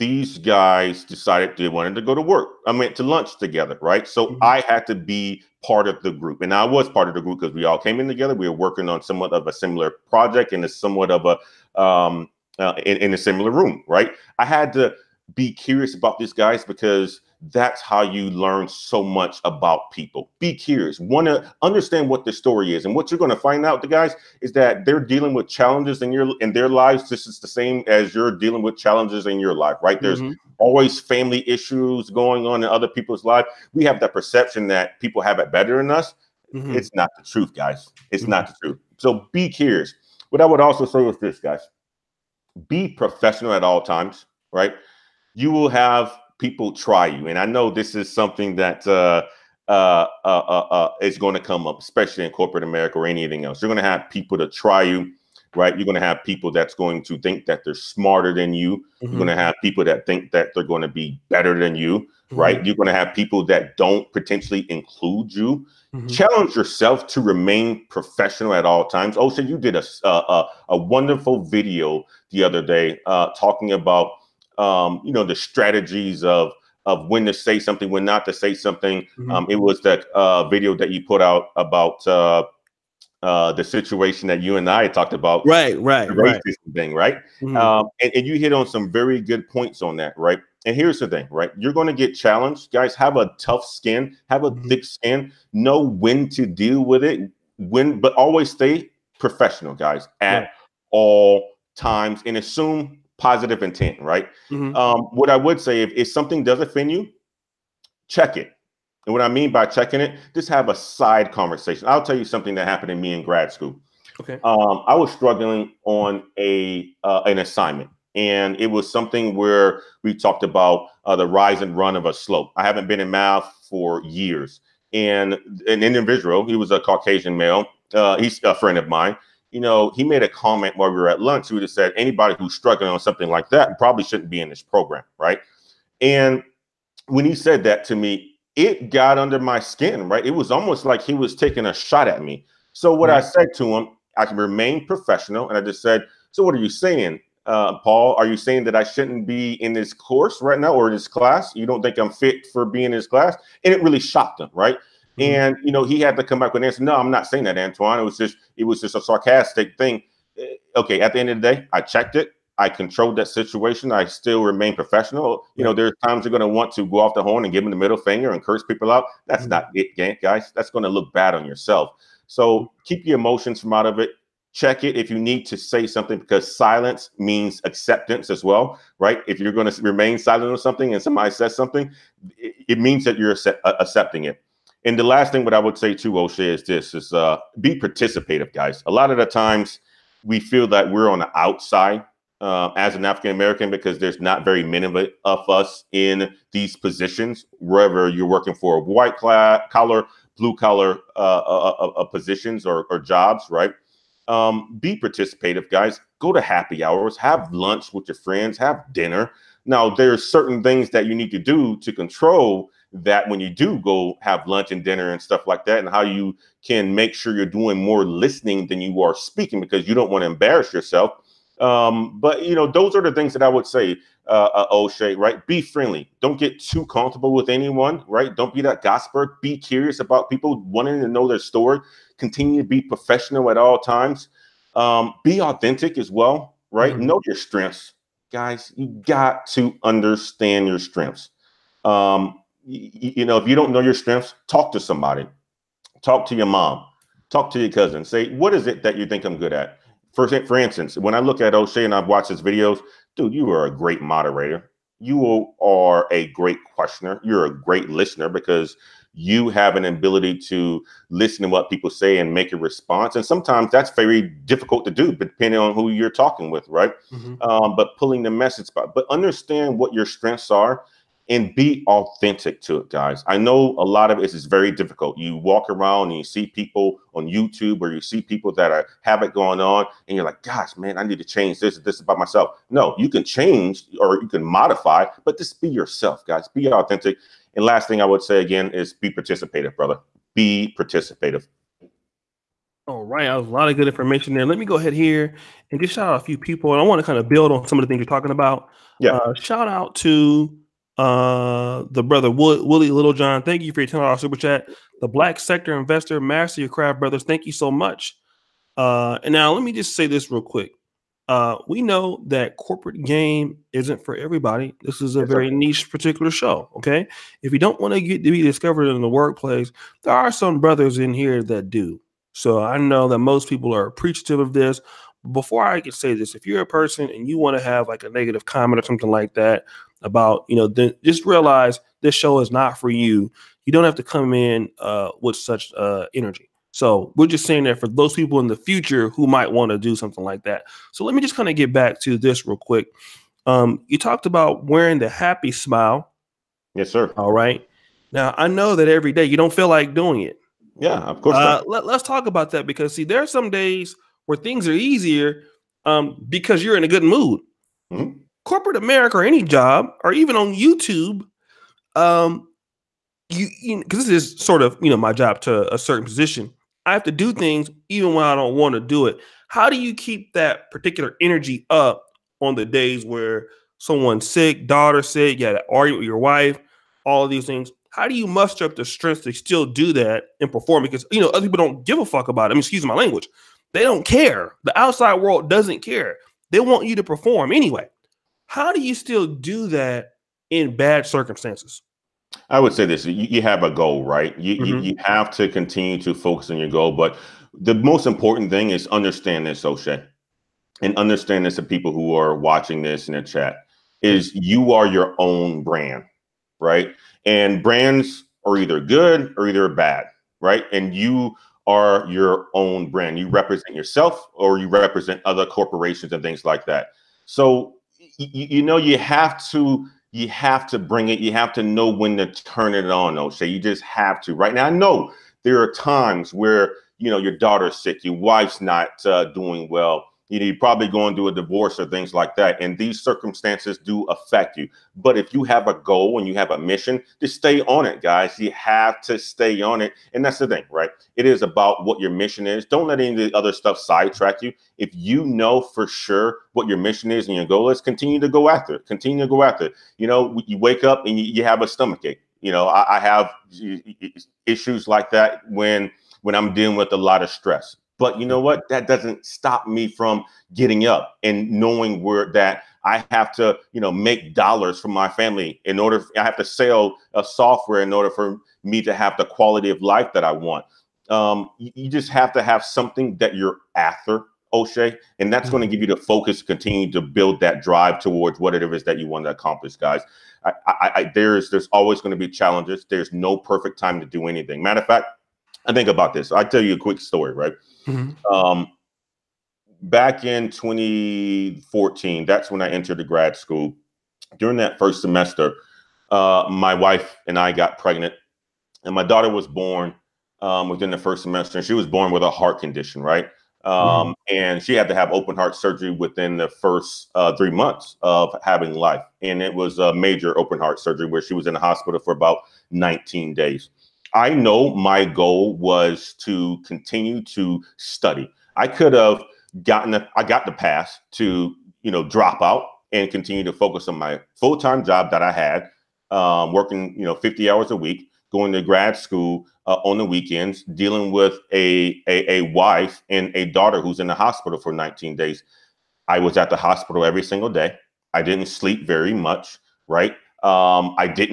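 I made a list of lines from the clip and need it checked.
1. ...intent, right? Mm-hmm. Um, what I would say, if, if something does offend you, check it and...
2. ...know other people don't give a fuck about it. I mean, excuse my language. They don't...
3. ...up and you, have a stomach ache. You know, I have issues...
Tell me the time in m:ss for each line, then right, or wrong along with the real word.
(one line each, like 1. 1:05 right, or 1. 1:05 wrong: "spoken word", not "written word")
1. 1:43 right
2. 6:21 right
3. 7:30 right.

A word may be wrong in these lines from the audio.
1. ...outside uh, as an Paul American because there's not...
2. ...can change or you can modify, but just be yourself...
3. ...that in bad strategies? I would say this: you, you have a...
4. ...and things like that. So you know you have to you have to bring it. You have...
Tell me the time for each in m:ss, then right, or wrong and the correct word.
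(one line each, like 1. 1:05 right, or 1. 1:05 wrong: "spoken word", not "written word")
1. 3:11 wrong: "African", not "Paul"
2. 4:43 right
3. 6:29 wrong: "circumstances", not "strategies"
4. 6:56 right.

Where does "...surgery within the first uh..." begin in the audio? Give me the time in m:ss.
8:25.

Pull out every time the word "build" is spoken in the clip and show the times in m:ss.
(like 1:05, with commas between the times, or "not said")
4:57, 7:57.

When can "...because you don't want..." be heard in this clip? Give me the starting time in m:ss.
3:39.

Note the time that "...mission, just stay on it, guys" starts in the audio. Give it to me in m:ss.
7:16.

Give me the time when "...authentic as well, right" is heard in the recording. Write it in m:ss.
3:55.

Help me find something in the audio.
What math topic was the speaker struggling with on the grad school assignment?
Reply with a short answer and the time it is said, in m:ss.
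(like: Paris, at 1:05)
Rise and run of a slope, at 2:01.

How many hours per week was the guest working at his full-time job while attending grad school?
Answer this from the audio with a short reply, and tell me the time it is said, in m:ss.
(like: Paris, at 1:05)
50, at 8:47.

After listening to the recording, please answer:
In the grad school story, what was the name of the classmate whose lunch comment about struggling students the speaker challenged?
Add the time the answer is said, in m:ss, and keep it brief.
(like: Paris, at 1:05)
Paul, at 2:27.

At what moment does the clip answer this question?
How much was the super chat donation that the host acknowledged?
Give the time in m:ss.
5:03.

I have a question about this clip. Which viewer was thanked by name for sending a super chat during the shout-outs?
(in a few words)
Willie Littlejohn.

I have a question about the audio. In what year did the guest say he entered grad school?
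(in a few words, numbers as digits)
2014.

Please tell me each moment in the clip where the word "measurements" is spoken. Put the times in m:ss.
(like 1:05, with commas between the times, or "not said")
not said.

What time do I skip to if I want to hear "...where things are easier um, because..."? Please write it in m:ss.
5:54.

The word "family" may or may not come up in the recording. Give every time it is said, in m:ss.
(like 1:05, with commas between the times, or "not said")
0:30, 7:45.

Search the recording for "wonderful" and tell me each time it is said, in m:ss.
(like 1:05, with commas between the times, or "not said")
1:10.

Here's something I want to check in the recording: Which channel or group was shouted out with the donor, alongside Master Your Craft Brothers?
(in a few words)
The Black Sector Investor.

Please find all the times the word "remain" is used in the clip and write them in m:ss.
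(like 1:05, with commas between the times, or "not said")
1:07, 2:24, 2:44, 2:59.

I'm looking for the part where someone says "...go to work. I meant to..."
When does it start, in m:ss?
0:02.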